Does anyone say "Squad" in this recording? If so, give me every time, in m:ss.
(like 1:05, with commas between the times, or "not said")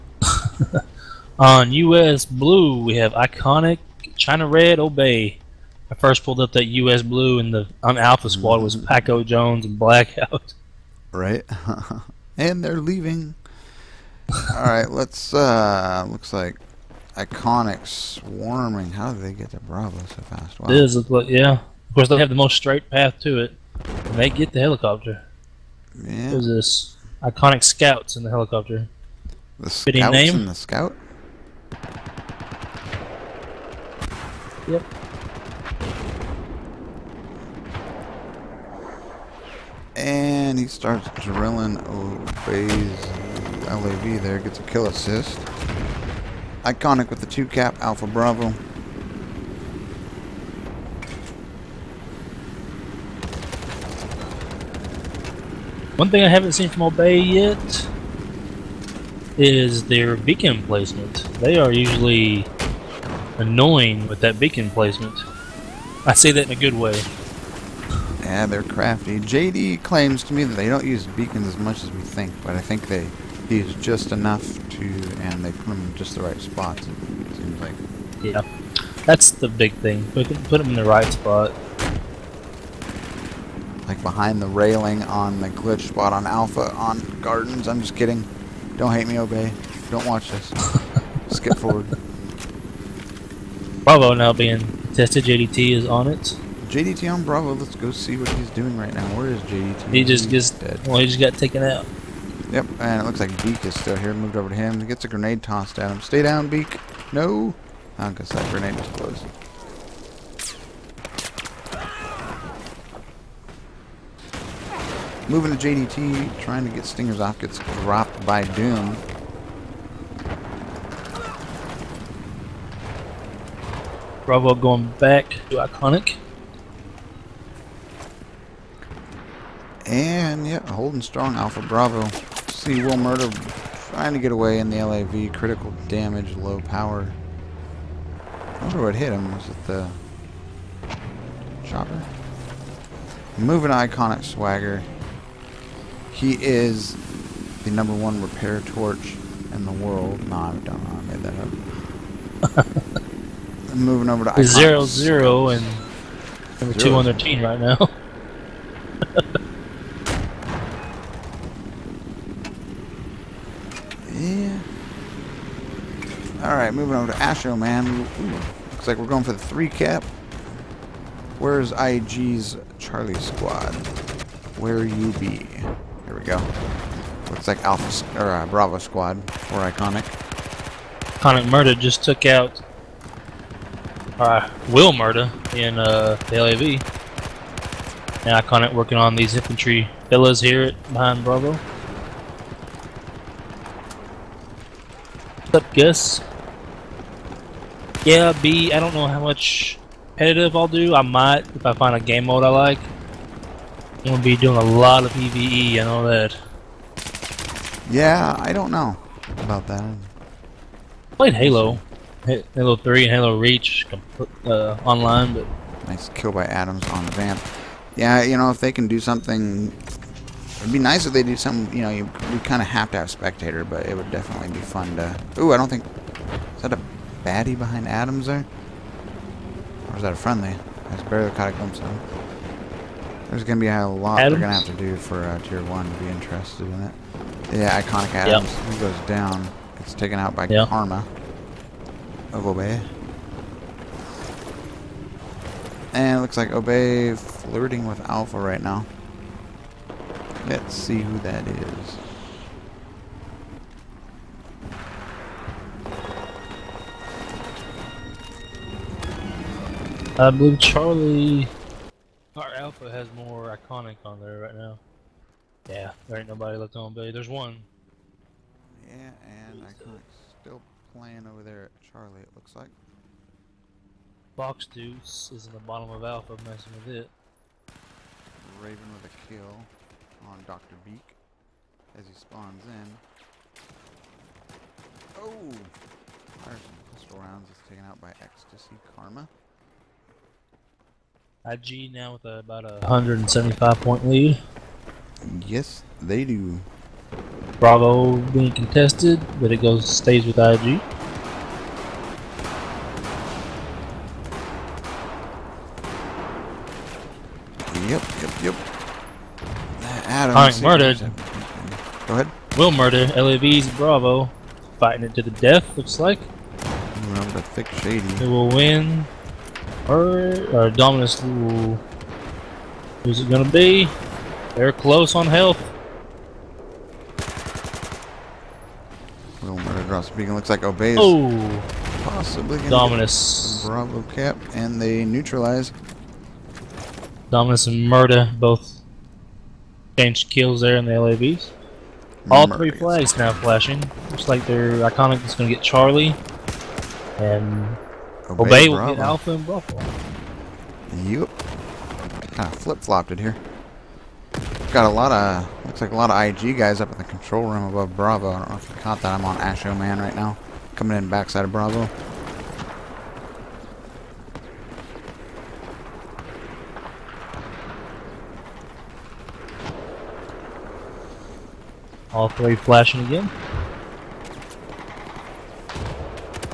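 0:08, 2:53, 2:58.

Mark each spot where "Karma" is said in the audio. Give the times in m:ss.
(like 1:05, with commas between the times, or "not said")
4:00, 4:48.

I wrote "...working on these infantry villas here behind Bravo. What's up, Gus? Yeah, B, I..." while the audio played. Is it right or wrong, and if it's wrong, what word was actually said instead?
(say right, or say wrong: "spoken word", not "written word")
right.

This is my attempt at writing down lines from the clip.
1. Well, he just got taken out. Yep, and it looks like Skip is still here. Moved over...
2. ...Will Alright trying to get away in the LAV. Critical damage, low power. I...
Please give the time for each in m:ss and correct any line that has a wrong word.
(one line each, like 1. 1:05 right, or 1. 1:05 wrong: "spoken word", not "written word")
1. 1:40 wrong: "Beak", not "Skip"
2. 2:12 wrong: "Murder", not "Alright".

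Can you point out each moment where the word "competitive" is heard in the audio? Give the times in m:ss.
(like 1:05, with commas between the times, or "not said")
3:20.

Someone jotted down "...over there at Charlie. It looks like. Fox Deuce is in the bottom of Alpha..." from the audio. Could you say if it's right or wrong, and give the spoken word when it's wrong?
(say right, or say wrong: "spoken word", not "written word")
right.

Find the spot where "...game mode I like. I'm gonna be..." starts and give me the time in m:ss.
3:21.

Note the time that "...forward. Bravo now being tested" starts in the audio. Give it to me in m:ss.
1:31.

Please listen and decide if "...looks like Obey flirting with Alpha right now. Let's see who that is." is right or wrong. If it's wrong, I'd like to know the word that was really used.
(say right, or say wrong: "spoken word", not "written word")
right.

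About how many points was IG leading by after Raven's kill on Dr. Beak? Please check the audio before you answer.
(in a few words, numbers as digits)
175.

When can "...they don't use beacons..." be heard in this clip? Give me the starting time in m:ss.
1:10.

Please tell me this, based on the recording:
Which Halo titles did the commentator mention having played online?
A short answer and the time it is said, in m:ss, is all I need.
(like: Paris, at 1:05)
Halo 3 and Halo Reach, at 3:32.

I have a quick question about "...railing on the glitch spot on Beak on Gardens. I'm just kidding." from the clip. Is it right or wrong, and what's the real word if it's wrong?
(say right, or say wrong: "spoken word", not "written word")
wrong: "Alpha", not "Beak".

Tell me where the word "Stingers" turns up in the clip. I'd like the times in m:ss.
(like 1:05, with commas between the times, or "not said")
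1:56.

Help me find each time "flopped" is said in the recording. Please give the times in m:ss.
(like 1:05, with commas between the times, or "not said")
5:52.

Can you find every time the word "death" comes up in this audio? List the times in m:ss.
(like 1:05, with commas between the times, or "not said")
5:15.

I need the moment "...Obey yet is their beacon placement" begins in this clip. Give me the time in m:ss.
0:56.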